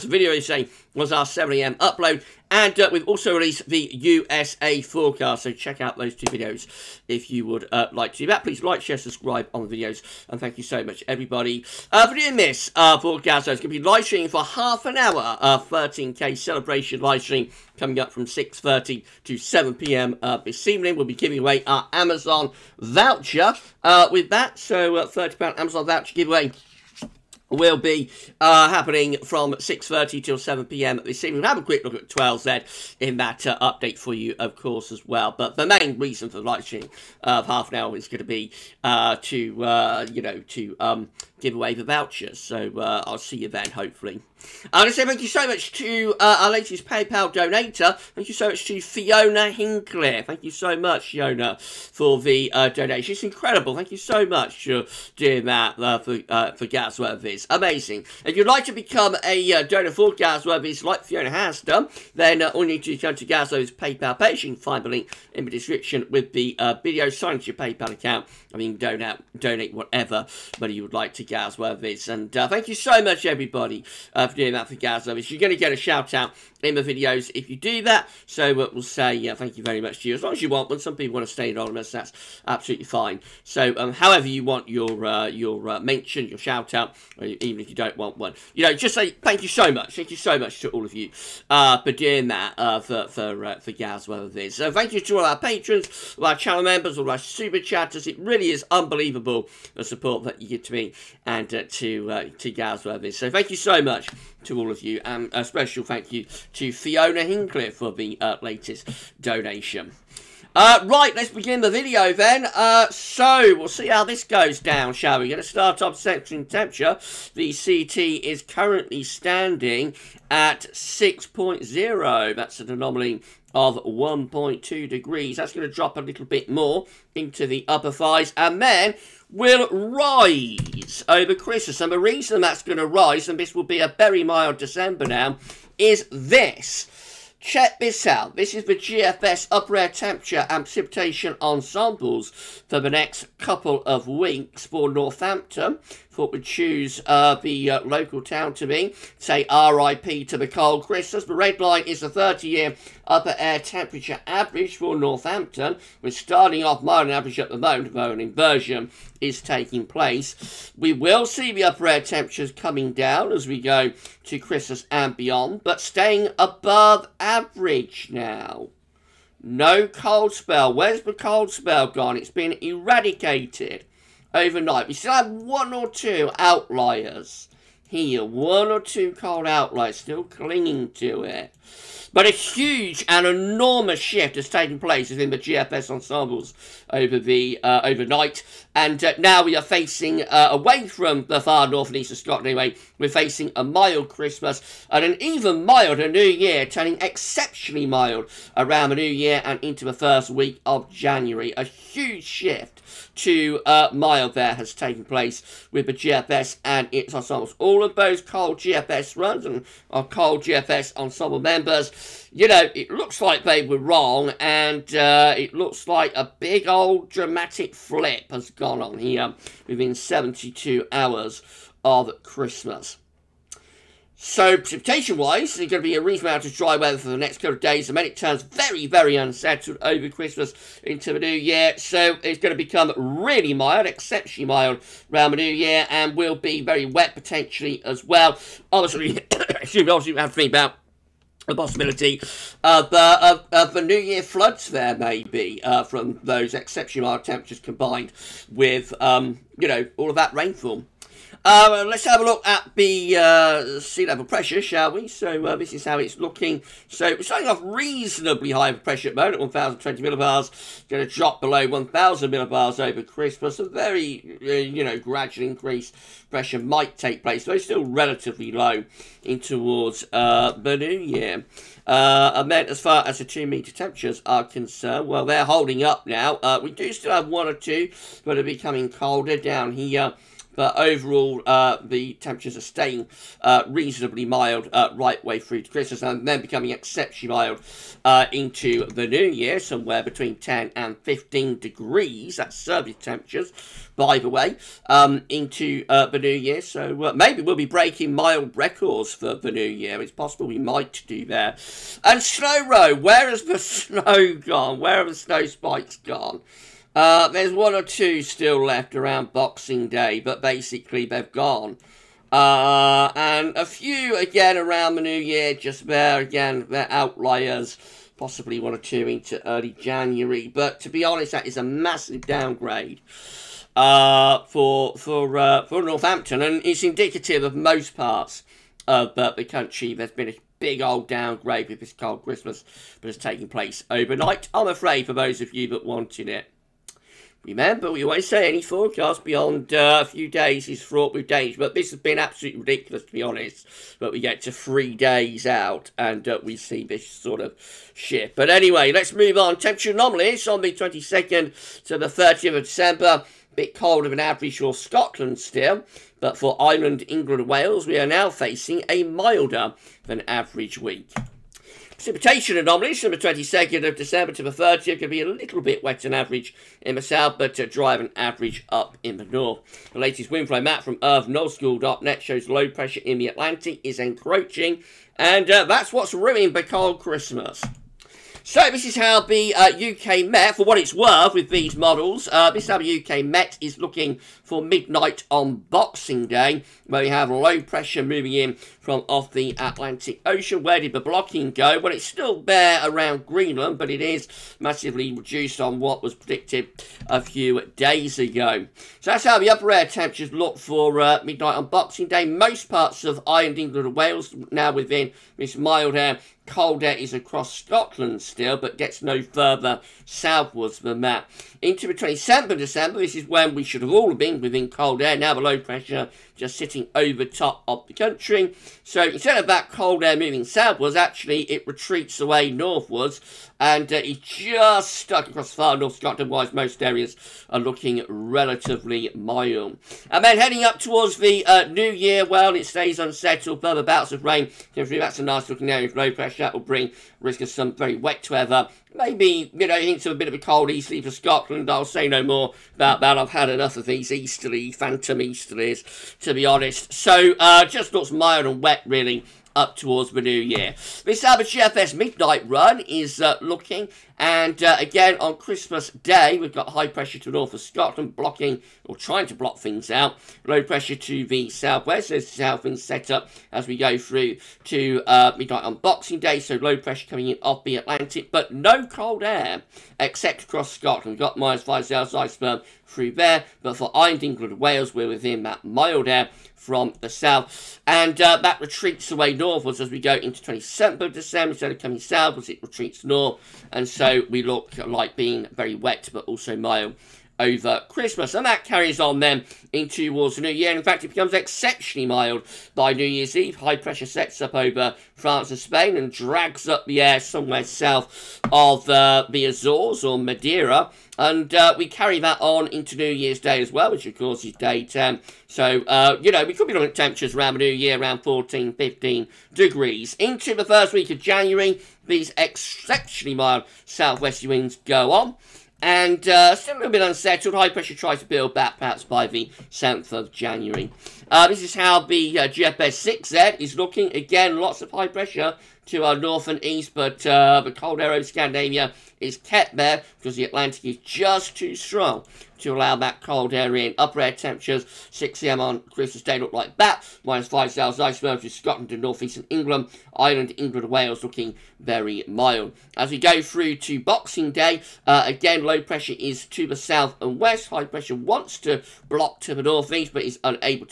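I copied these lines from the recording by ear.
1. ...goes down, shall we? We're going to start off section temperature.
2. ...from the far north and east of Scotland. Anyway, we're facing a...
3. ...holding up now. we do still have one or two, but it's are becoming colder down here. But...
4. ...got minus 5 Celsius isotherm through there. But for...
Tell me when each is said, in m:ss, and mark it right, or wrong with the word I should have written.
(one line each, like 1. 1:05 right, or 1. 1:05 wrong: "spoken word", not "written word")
1. 1:54 right
2. 3:10 right
3. 4:35 right
4. 7:51 right.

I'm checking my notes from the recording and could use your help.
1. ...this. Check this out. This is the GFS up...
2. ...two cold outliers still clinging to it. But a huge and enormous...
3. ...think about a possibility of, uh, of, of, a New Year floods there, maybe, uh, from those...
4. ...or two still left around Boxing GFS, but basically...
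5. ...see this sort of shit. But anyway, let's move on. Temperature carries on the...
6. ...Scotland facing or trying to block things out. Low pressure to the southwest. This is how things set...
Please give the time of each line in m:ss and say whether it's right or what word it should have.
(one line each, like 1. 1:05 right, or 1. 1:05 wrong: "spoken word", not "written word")
1. 2:16 right
2. 2:58 right
3. 4:00 right
4. 5:07 wrong: "Day", not "GFS"
5. 5:46 wrong: "anomalies", not "carries"
6. 7:37 wrong: "blocking", not "facing".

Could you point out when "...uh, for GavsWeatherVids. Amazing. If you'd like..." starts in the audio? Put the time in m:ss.
0:56.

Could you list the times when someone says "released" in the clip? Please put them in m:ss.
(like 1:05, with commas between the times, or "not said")
0:03.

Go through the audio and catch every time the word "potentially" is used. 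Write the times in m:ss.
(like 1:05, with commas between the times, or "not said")
3:57.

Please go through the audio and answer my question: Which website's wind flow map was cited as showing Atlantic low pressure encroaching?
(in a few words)
earth.nullschool.net.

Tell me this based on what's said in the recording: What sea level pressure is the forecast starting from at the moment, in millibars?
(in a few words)
1,020.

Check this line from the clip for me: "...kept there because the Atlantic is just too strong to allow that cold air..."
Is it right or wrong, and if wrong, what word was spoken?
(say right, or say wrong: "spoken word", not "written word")
right.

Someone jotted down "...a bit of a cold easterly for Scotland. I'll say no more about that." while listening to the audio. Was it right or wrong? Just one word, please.
right.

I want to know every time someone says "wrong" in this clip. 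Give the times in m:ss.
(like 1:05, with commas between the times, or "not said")
3:33.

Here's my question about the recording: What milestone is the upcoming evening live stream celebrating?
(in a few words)
13K.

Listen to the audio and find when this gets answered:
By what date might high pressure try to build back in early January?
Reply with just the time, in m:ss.
8:39.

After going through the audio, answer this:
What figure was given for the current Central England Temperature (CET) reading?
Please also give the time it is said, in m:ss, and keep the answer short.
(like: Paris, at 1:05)
6.0, at 2:00.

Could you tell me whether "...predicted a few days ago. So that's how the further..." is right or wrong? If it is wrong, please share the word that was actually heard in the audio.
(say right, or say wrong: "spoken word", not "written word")
wrong: "upper", not "further".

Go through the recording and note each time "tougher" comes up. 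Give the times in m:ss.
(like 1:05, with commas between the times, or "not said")
not said.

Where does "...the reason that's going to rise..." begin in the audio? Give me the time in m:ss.
2:11.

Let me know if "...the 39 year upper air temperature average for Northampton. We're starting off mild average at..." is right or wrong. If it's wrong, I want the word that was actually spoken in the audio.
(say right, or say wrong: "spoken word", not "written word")
wrong: "30", not "39".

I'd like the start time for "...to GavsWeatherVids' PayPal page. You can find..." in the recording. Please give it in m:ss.
1:03.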